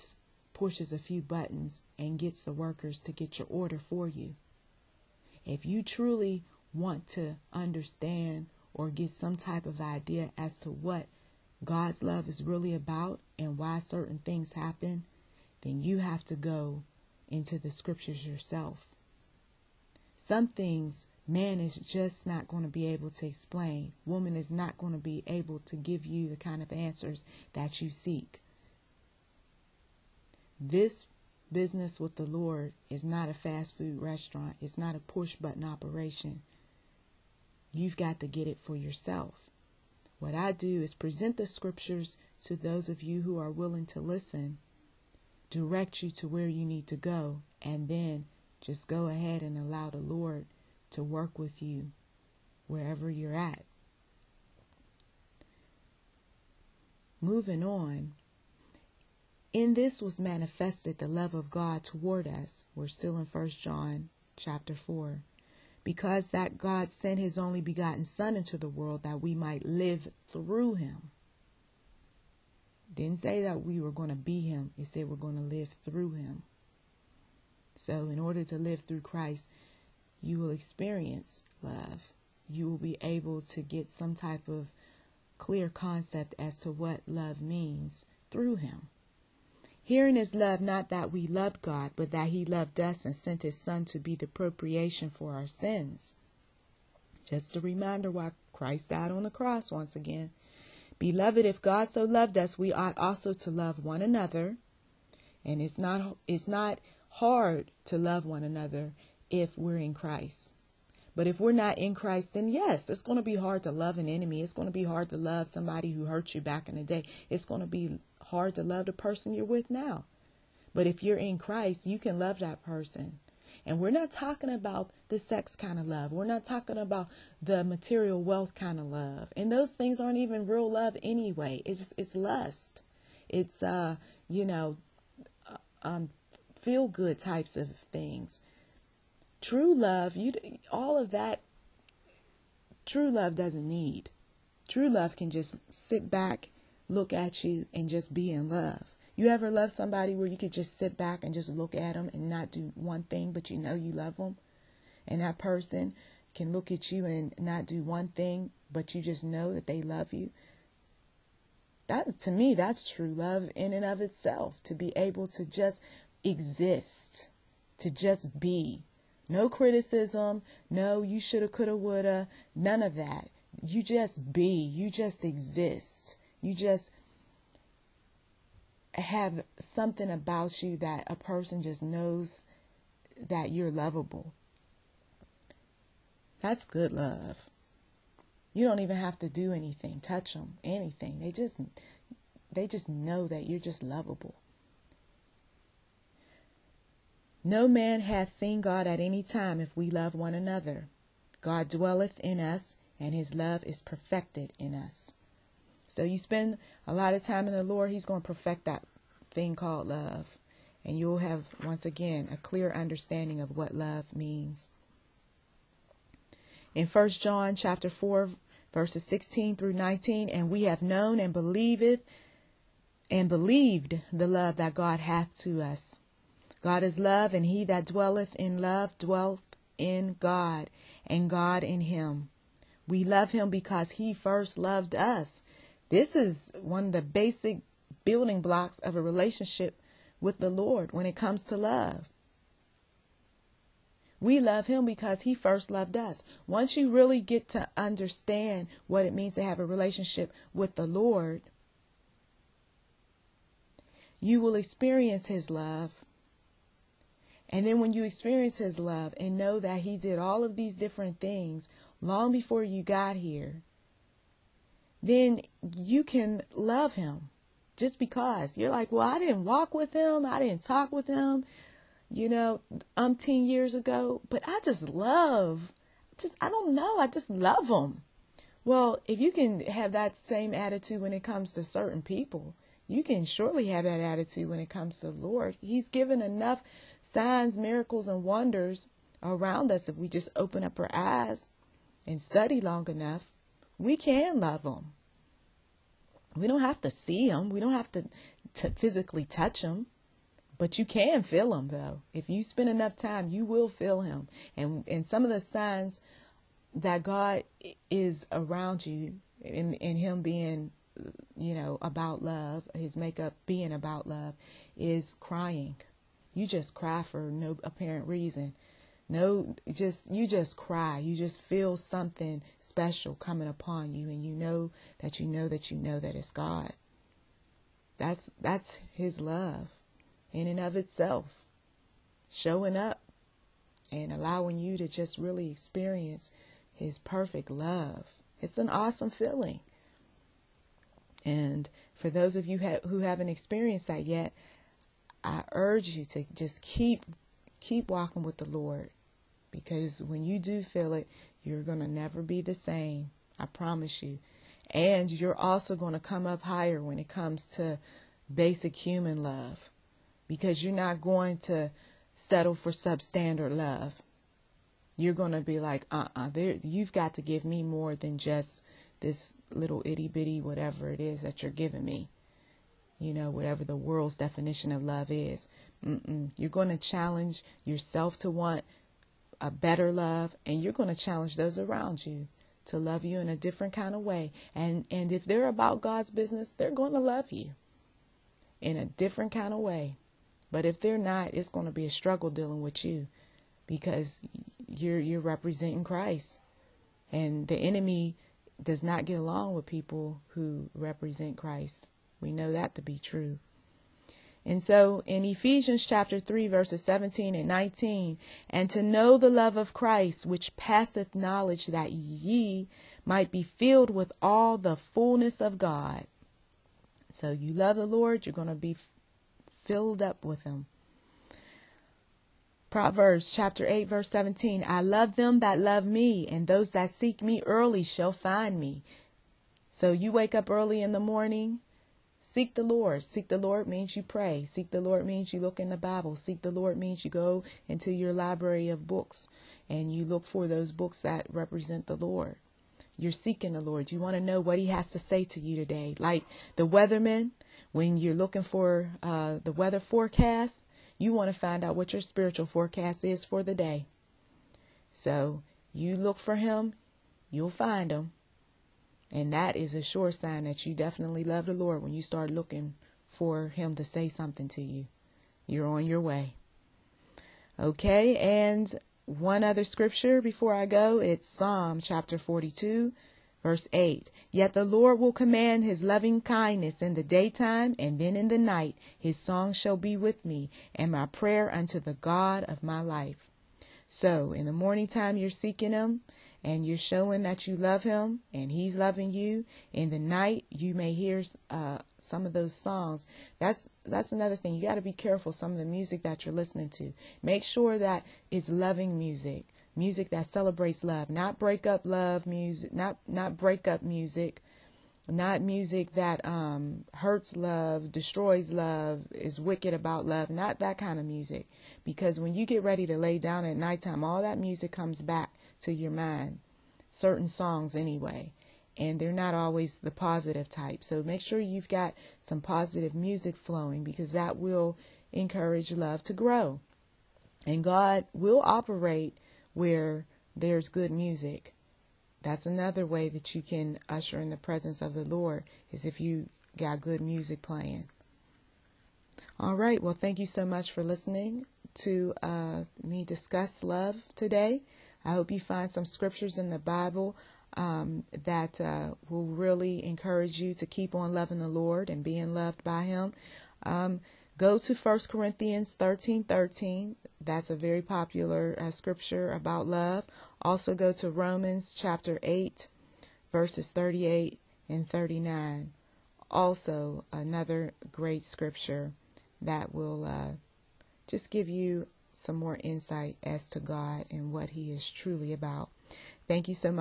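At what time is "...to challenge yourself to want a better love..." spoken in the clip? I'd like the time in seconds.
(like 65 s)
376 s.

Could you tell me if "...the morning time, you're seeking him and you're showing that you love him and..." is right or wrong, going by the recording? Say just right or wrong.
right.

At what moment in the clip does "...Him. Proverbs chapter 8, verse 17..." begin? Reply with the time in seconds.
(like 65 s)
420 s.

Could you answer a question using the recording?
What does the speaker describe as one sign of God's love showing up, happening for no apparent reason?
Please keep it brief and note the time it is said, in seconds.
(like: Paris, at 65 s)
crying, at 315 s.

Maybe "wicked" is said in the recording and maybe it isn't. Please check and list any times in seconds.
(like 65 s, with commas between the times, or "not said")
509 s.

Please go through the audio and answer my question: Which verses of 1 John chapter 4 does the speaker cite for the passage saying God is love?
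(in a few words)
16 through 19.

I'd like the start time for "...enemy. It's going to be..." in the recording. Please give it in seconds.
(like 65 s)
114 s.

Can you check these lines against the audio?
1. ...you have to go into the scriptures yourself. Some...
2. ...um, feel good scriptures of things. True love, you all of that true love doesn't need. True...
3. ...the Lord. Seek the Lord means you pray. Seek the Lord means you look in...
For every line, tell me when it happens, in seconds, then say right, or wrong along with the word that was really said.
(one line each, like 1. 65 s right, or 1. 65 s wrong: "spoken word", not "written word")
1. 15 s right
2. 135 s wrong: "types", not "scriptures"
3. 432 s right.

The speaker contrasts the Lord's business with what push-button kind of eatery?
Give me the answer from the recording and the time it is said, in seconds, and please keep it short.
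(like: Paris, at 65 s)
fast food restaurant, at 33 s.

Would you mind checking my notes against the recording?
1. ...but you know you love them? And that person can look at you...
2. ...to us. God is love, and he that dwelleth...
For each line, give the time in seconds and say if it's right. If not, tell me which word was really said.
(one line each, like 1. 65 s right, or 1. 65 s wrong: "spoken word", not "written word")
1. 153 s right
2. 225 s right.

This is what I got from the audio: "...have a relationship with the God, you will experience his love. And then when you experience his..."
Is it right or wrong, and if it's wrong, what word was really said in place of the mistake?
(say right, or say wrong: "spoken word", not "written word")
wrong: "Lord", not "God".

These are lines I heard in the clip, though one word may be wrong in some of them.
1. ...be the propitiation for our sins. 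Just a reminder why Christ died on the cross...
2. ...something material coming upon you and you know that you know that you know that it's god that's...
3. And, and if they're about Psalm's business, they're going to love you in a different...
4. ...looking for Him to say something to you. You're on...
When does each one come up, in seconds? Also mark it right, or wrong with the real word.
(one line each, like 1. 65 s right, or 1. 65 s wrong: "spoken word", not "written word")
1. 93 s right
2. 321 s wrong: "special", not "material"
3. 384 s wrong: "God", not "Psalm"
4. 462 s right.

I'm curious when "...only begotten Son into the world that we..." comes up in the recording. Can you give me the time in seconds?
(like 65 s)
67 s.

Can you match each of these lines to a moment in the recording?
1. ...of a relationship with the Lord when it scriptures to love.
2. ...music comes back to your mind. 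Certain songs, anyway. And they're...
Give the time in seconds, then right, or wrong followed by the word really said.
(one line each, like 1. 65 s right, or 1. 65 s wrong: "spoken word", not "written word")
1. 238 s wrong: "comes", not "scriptures"
2. 514 s right.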